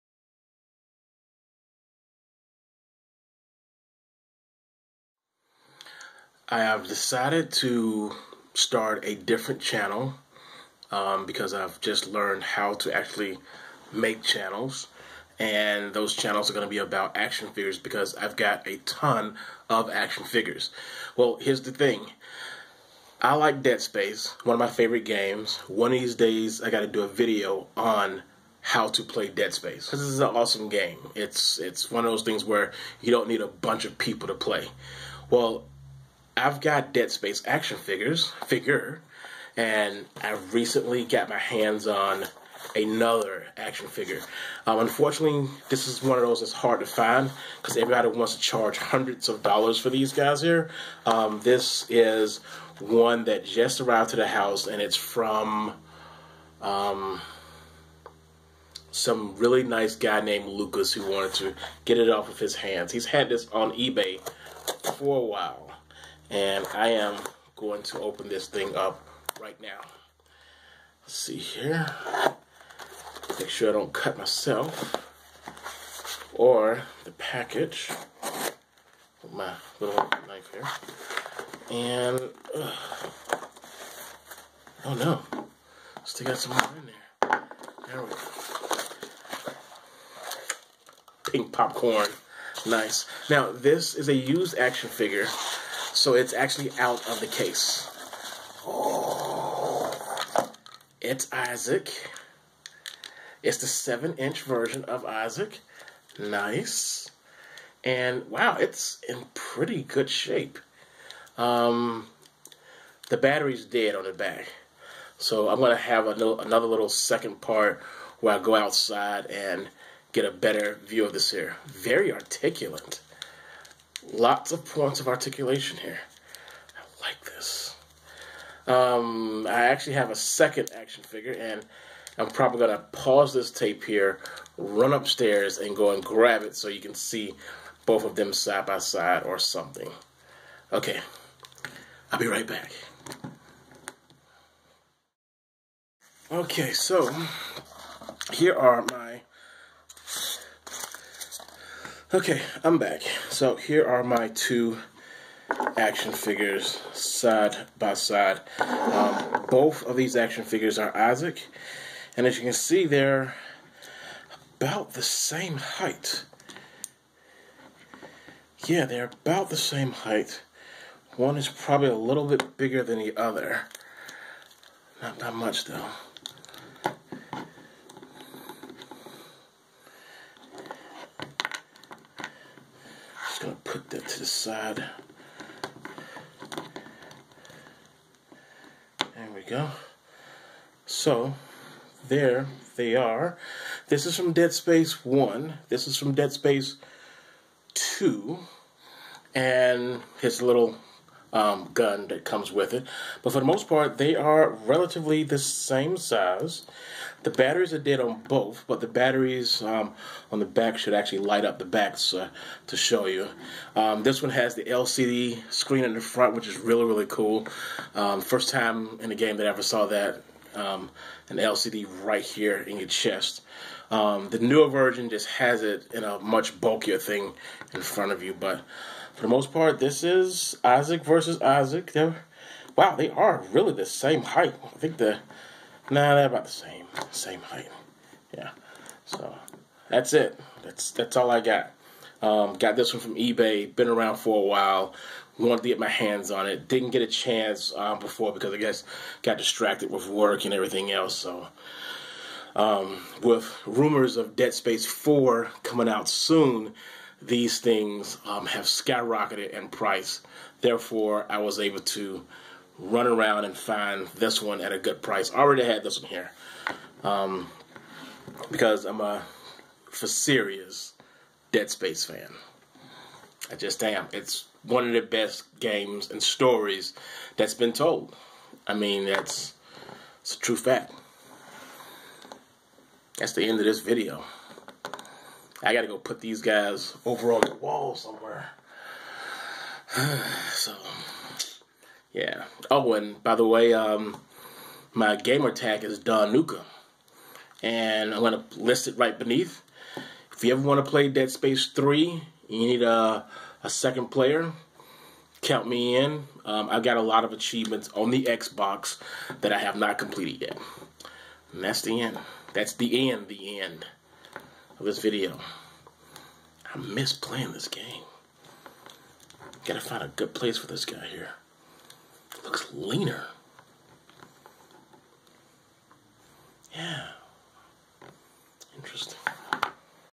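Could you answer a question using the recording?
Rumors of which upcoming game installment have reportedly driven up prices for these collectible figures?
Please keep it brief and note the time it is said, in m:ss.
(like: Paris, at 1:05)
Dead Space 4, at 4:14.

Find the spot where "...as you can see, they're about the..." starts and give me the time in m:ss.
2:42.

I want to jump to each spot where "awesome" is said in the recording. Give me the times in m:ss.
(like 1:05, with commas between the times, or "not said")
0:30.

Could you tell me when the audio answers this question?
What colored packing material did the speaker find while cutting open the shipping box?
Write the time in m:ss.
1:31.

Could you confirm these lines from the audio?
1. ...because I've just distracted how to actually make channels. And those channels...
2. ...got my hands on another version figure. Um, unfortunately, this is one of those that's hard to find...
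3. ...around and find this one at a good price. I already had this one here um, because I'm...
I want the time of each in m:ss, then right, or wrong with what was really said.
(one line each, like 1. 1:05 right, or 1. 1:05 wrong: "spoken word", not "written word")
1. 0:11 wrong: "learned", not "distracted"
2. 0:41 wrong: "action", not "version"
3. 4:23 right.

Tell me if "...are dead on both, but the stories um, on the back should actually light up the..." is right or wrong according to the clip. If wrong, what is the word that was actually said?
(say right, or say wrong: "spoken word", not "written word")
wrong: "batteries", not "stories".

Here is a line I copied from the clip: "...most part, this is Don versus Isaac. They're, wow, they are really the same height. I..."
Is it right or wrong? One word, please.
wrong.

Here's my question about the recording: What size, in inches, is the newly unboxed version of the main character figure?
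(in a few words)
7 inch.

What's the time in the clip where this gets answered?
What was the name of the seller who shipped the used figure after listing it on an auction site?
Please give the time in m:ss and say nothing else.
1:00.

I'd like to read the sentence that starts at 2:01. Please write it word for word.
Very articulate lots of points of articulation here.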